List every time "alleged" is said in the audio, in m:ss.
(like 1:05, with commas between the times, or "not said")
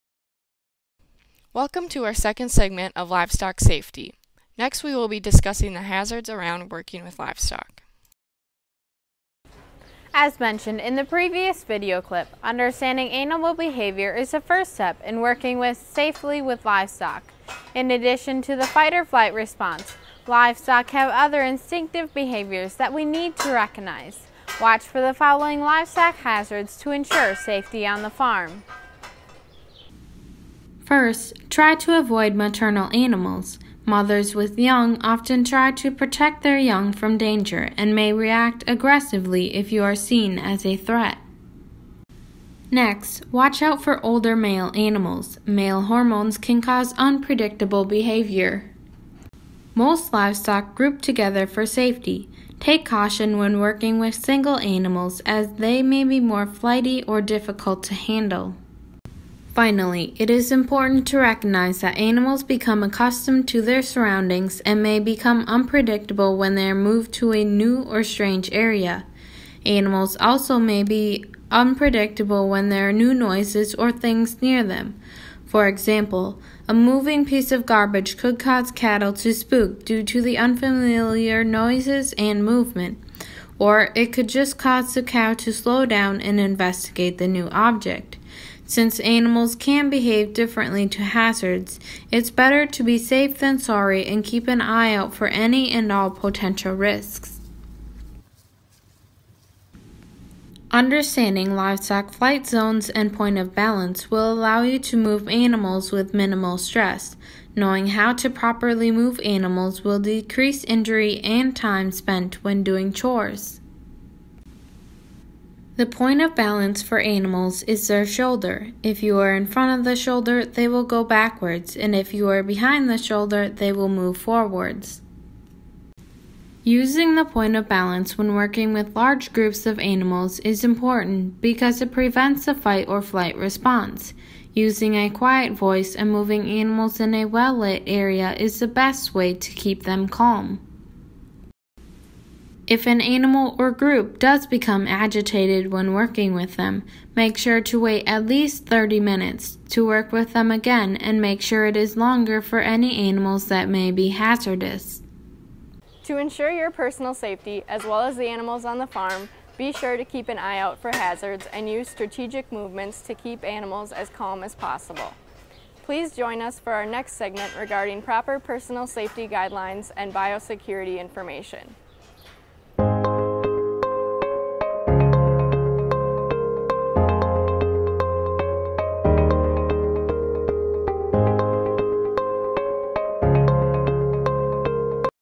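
not said.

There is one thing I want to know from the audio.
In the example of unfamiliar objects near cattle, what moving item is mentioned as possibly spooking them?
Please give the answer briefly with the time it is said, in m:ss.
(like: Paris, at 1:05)
Garbage, at 1:17.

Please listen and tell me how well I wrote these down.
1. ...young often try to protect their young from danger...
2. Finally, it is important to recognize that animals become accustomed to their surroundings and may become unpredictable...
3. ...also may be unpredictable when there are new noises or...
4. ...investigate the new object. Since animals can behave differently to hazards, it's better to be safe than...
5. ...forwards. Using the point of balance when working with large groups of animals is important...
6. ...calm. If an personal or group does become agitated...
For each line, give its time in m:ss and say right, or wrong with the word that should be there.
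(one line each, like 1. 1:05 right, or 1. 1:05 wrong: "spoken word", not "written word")
1. 0:34 right
2. 0:59 right
3. 1:10 right
4. 1:26 right
5. 2:04 right
6. 2:20 wrong: "animal", not "personal".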